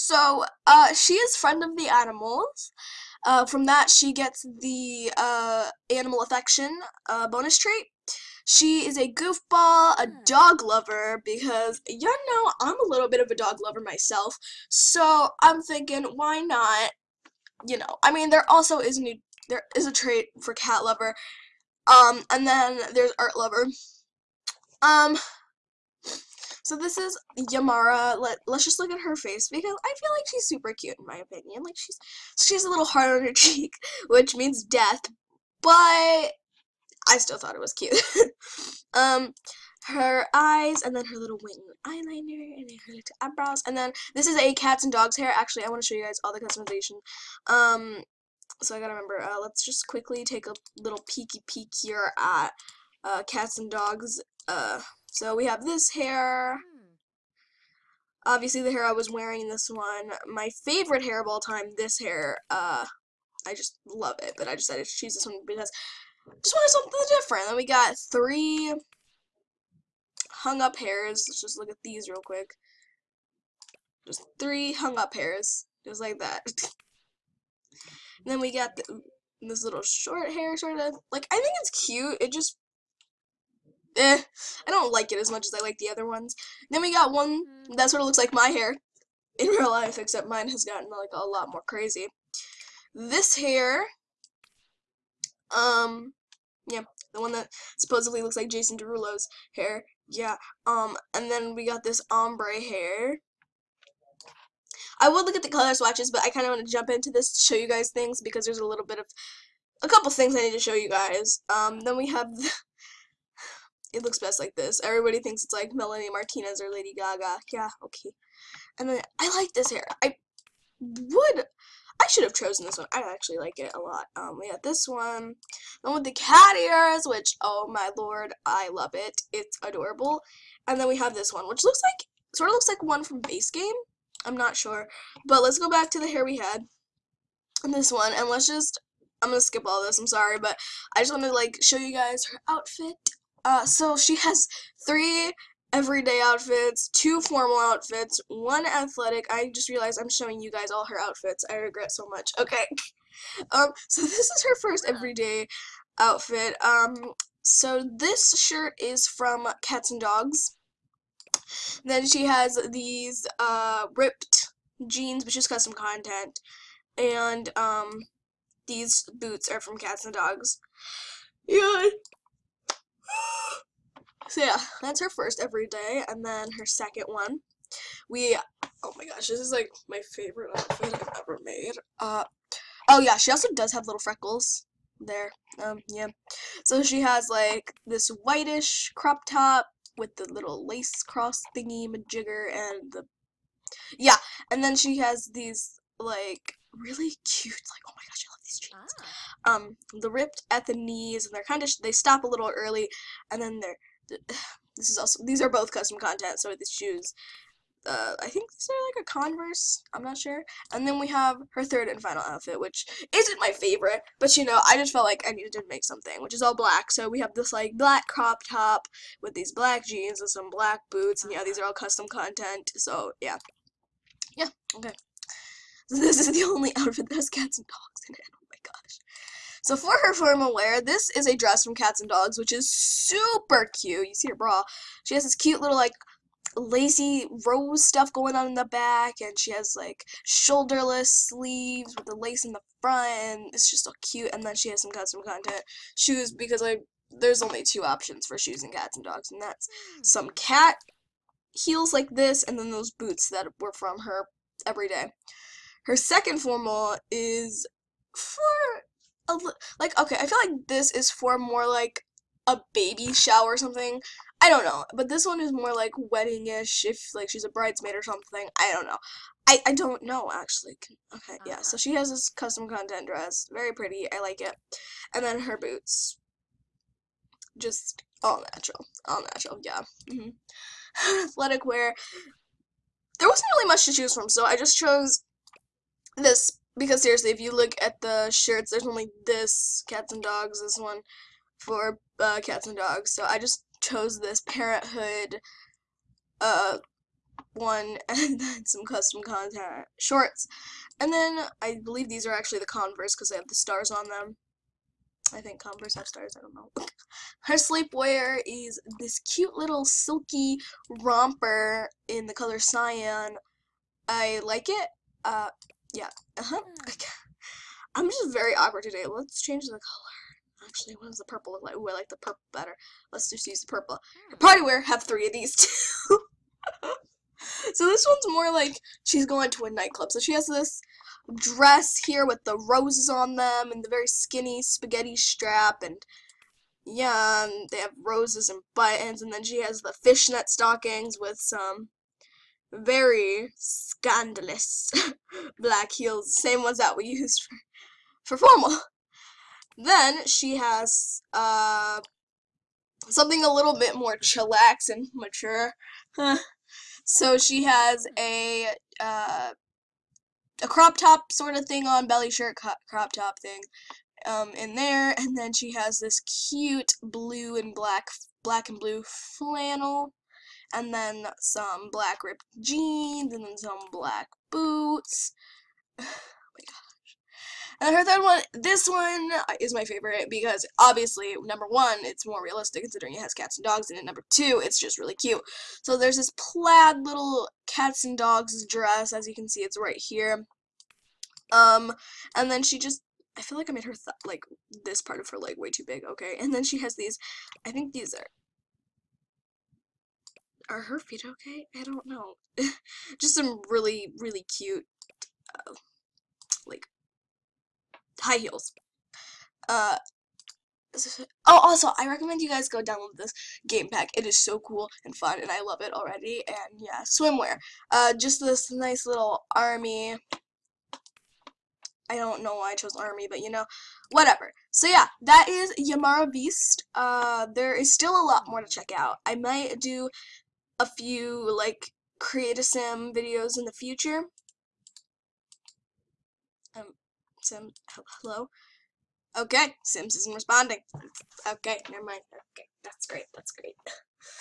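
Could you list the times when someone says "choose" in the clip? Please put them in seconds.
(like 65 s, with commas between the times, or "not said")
64 s, 283 s.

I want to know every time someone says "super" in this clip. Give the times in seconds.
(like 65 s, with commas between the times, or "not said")
30 s, 232 s.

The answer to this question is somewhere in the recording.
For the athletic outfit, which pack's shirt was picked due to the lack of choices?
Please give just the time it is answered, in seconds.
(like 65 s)
294 s.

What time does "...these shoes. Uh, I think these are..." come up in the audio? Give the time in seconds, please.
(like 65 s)
206 s.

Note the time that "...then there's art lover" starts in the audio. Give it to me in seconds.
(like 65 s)
22 s.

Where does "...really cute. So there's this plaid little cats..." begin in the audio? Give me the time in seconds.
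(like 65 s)
384 s.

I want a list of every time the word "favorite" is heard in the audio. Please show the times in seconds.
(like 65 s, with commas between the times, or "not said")
60 s, 180 s, 213 s, 379 s.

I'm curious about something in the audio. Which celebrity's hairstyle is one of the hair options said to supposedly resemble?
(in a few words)
Jason Derulo.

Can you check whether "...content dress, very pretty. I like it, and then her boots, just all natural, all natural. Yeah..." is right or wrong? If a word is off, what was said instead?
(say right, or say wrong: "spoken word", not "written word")
right.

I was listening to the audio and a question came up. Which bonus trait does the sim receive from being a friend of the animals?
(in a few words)
Animal affection.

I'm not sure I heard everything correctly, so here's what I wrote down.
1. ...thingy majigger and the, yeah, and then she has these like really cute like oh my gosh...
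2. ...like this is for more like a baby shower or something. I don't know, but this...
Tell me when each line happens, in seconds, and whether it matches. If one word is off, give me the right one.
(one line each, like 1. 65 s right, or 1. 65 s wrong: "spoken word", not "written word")
1. 191 s right
2. 260 s right.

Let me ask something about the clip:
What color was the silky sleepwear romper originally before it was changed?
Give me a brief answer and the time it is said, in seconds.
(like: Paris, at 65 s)
Cyan, at 312 s.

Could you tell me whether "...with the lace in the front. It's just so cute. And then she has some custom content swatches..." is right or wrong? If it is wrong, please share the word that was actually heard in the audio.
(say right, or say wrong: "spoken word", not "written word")
wrong: "shoes", not "swatches".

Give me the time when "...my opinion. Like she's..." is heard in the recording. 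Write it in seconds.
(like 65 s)
31 s.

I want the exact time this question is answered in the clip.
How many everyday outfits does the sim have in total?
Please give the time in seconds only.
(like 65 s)
144 s.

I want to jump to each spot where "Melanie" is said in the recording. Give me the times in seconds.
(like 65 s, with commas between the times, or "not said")
115 s.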